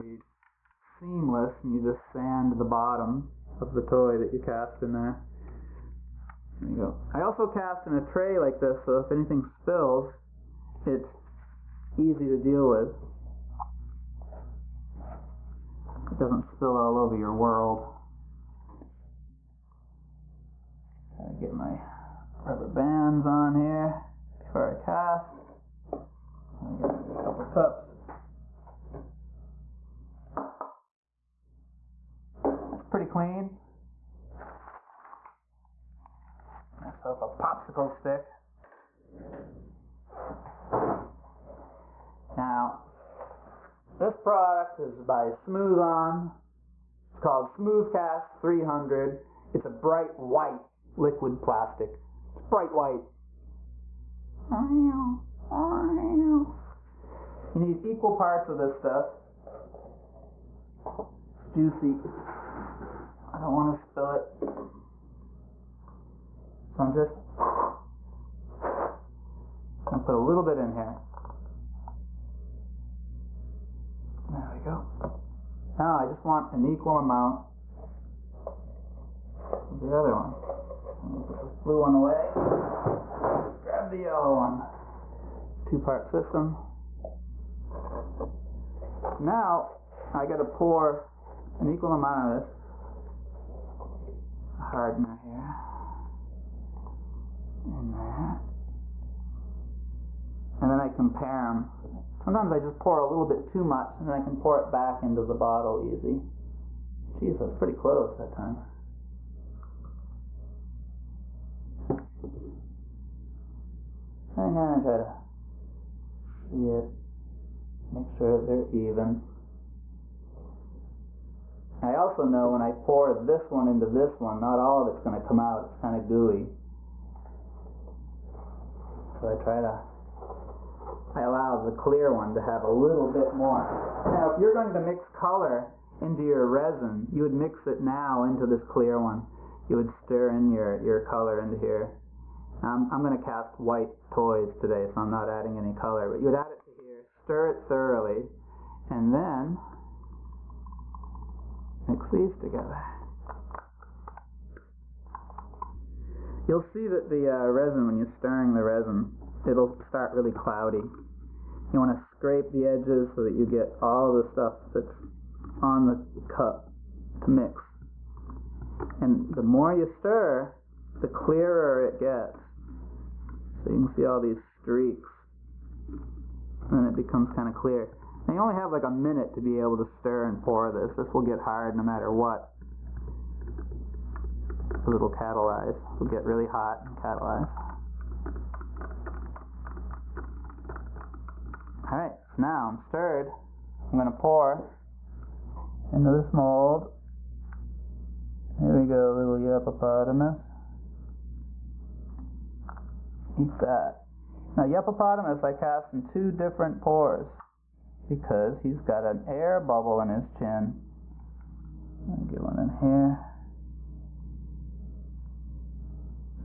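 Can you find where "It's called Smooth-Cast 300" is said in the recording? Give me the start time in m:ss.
0:47.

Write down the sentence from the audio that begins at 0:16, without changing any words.
It doesn't spill all over your world.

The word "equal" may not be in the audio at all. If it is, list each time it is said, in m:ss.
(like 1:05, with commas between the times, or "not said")
0:57, 1:16, 1:31.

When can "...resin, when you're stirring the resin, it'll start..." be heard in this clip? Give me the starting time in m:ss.
2:37.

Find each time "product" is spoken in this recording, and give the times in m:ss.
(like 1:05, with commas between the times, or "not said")
0:44.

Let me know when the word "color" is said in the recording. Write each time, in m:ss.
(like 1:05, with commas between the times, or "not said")
2:15, 2:21, 2:25.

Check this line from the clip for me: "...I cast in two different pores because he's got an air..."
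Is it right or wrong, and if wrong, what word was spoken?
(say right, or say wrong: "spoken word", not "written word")
right.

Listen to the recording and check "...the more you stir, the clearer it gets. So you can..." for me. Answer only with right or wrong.
right.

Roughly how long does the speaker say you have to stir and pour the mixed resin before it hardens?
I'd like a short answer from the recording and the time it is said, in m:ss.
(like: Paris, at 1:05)
a minute, at 2:58.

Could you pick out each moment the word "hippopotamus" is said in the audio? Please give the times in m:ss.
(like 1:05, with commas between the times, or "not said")
3:19, 3:24.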